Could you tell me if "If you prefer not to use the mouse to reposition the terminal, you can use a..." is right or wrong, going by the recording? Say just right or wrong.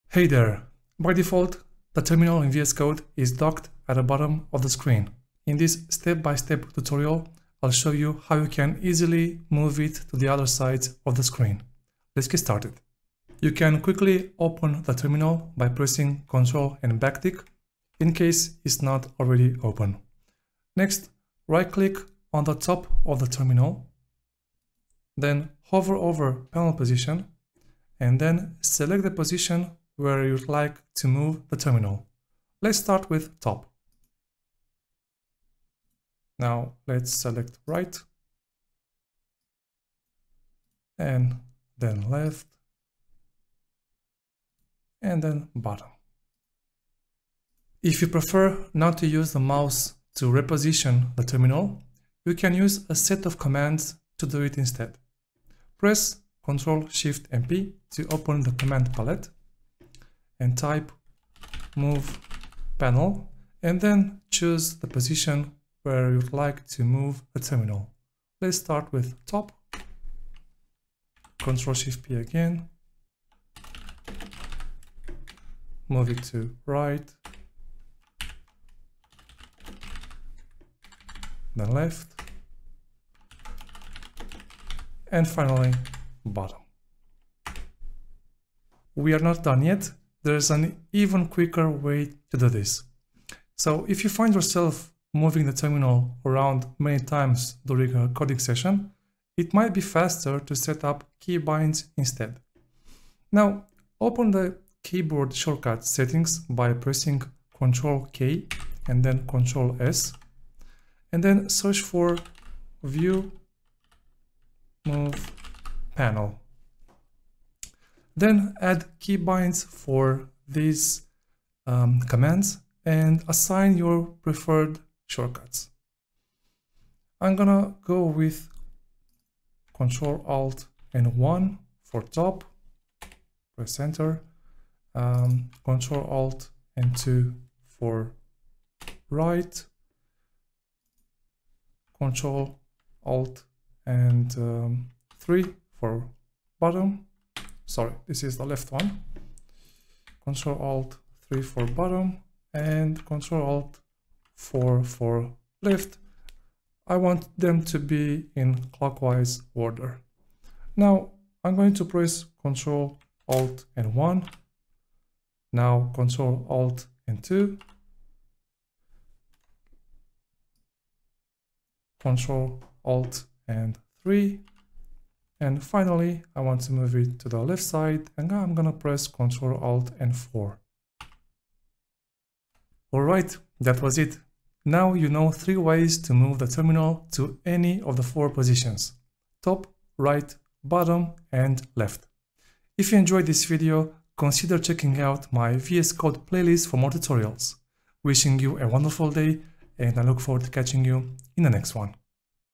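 right.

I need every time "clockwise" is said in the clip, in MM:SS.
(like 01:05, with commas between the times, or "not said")
02:38.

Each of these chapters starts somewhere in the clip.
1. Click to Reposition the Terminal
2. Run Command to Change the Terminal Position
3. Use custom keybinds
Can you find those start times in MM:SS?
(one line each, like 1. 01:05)
1. 00:13
2. 00:47
3. 01:29.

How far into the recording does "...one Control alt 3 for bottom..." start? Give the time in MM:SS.
02:28.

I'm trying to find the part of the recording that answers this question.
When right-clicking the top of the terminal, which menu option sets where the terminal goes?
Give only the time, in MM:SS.
00:26.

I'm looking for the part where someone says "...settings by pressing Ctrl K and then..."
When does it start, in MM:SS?
01:45.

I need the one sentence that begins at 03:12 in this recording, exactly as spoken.
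If you enjoyed this video, consider checking out my VS Code playlist for more tutorials.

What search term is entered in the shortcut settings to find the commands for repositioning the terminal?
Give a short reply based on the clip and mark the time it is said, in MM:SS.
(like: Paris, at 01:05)
View Move Panel, at 01:52.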